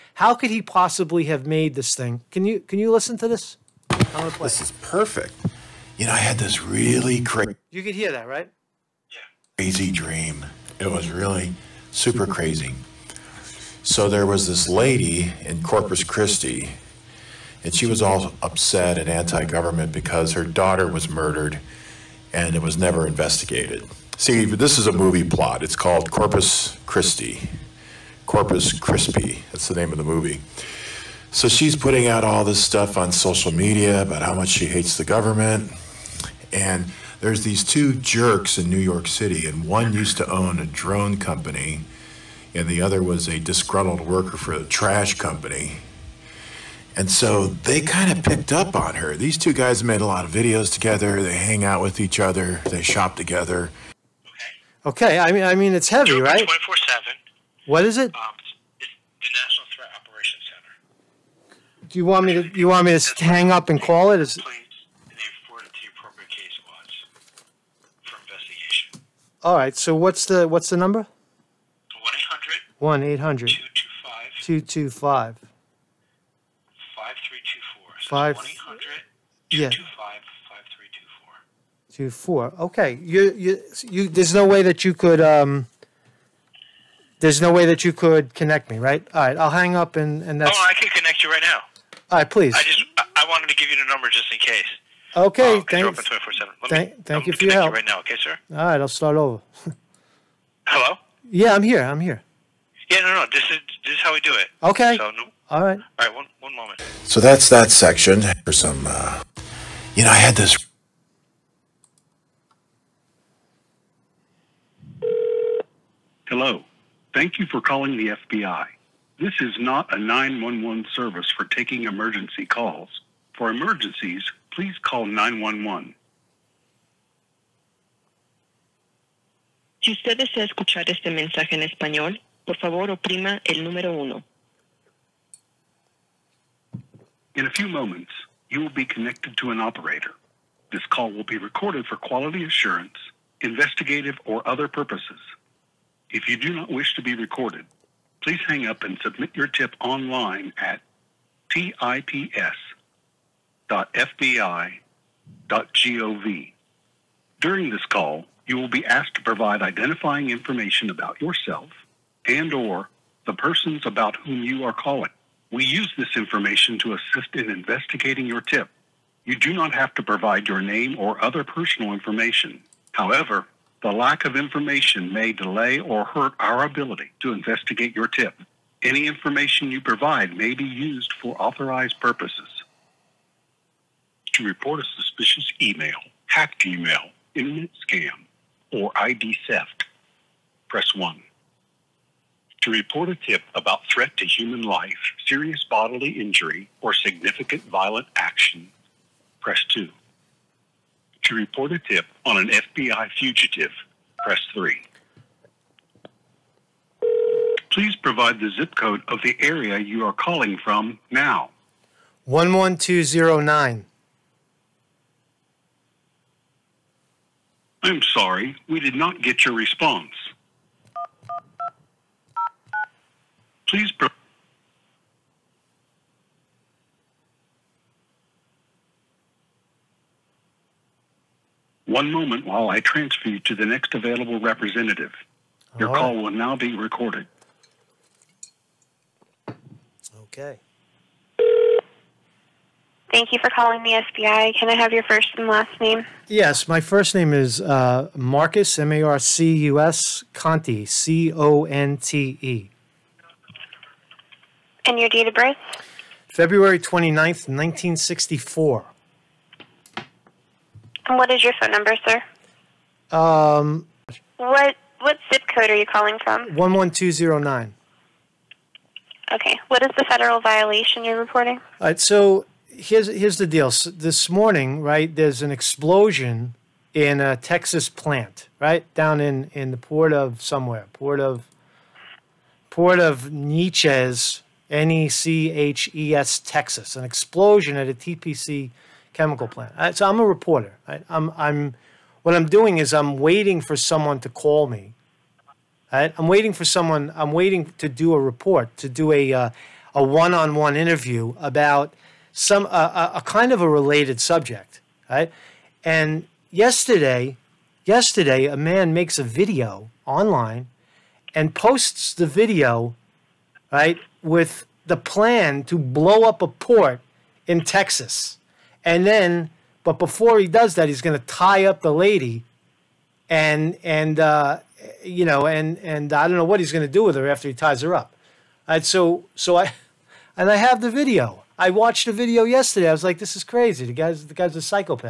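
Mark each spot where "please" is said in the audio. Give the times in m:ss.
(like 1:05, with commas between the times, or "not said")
1:32, 2:04, 2:28, 3:27, 3:43.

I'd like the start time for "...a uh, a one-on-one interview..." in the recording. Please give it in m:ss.
4:59.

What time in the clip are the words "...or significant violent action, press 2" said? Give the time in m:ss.
3:16.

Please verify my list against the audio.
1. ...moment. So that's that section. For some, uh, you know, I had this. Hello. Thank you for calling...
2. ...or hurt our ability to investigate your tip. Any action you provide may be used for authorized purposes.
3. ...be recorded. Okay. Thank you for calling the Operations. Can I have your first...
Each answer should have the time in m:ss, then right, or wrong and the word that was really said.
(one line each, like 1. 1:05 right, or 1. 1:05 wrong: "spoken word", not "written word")
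1. 1:46 right
2. 2:55 wrong: "information", not "action"
3. 3:56 wrong: "FBI", not "Operations".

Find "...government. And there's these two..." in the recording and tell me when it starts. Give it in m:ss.
0:35.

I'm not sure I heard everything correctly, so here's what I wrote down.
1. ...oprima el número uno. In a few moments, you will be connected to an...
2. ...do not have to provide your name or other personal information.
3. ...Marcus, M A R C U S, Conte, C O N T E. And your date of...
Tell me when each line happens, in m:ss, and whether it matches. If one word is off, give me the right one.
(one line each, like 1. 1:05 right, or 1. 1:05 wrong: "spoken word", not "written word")
1. 2:12 right
2. 2:49 right
3. 4:08 right.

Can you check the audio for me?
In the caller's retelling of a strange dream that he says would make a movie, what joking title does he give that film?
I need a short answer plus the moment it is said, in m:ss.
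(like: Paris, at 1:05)
Corpus Crispy, at 0:28.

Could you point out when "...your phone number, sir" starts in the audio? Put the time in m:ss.
4:21.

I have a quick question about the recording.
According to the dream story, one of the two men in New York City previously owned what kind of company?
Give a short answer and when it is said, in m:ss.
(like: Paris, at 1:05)
drone company, at 0:40.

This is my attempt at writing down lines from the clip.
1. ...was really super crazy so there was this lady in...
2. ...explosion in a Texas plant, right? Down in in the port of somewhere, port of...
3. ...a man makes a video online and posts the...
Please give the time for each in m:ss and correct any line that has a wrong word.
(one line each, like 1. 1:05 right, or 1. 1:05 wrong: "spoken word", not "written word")
1. 0:10 right
2. 4:35 right
3. 5:08 right.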